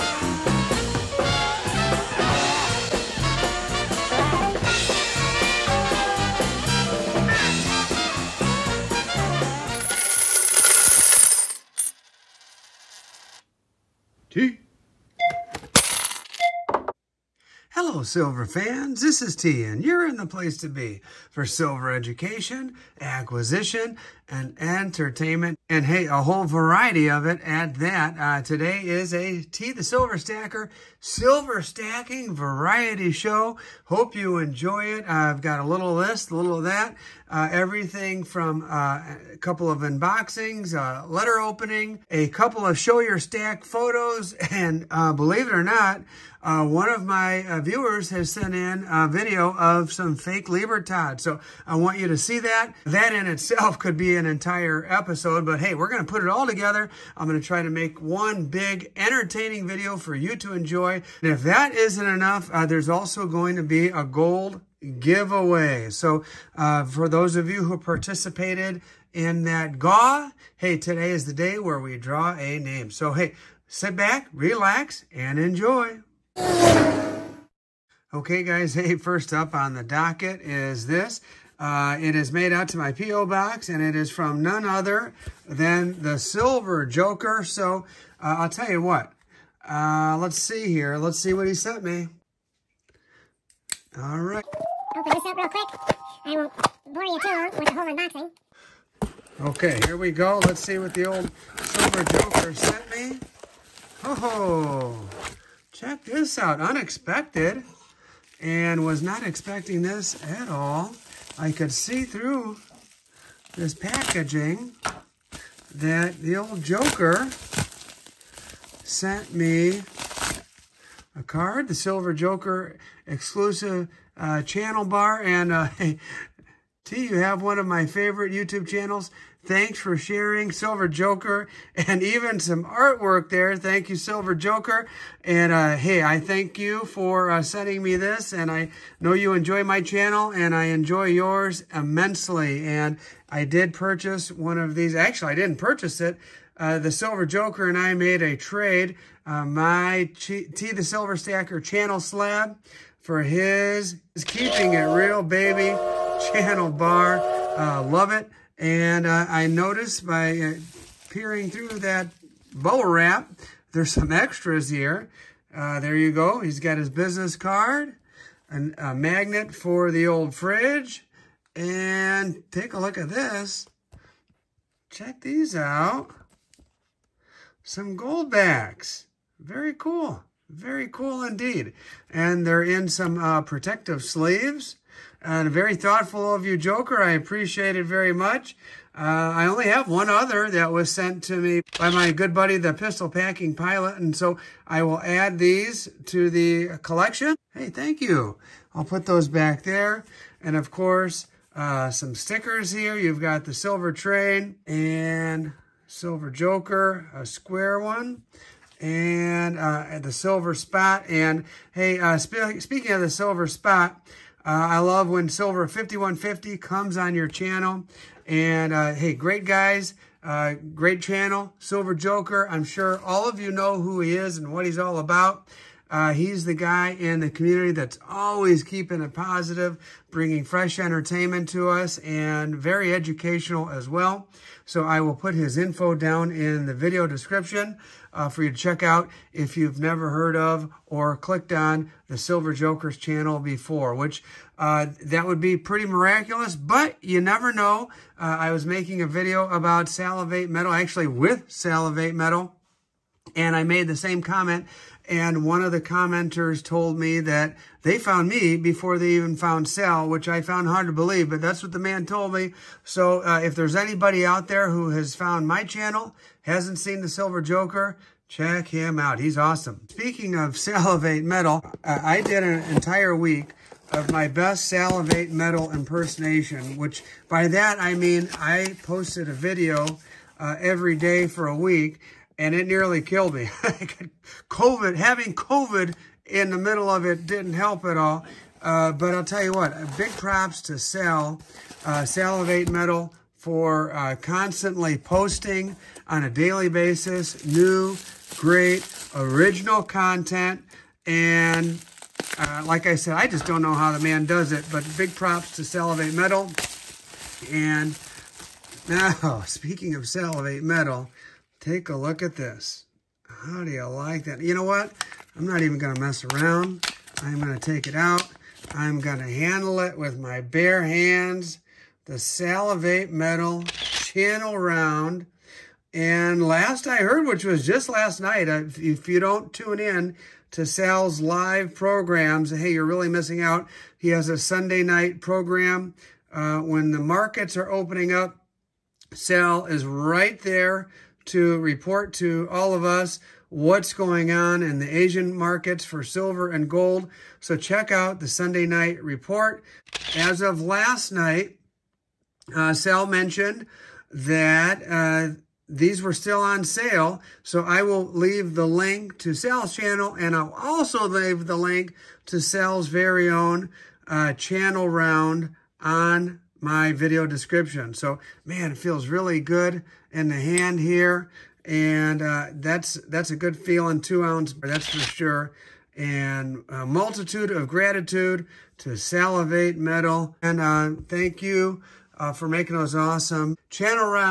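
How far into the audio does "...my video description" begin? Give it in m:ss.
6:06.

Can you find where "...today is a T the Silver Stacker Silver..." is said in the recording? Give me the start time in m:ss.
0:28.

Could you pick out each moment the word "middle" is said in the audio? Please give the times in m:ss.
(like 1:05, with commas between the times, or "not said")
4:46.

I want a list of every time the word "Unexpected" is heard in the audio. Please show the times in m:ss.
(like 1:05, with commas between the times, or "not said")
1:46.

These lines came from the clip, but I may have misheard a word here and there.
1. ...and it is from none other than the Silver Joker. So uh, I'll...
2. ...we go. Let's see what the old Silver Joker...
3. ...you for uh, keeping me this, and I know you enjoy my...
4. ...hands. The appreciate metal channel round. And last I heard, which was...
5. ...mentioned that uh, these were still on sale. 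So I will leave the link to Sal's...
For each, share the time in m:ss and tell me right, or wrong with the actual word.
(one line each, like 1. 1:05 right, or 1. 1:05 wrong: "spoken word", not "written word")
1. 1:23 right
2. 1:39 right
3. 2:16 wrong: "sending", not "keeping"
4. 5:20 wrong: "salivate", not "appreciate"
5. 5:53 right.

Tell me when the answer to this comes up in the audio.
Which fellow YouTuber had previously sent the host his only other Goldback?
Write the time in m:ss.
3:12.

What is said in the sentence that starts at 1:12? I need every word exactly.
So hey, sit back, relax, and enjoy.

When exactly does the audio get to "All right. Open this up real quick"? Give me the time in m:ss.
1:34.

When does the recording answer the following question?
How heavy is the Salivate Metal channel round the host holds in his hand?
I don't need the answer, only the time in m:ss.
6:13.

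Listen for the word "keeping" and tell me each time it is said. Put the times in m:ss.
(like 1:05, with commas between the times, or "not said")
2:34, 3:48.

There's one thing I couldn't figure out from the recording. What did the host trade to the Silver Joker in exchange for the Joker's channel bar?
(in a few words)
T the Silver Stacker channel slab.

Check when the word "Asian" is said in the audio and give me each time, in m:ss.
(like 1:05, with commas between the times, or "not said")
5:44.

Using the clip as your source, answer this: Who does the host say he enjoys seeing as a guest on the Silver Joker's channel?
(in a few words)
Silver 5150.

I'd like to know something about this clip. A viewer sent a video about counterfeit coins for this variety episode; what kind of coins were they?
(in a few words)
Libertad.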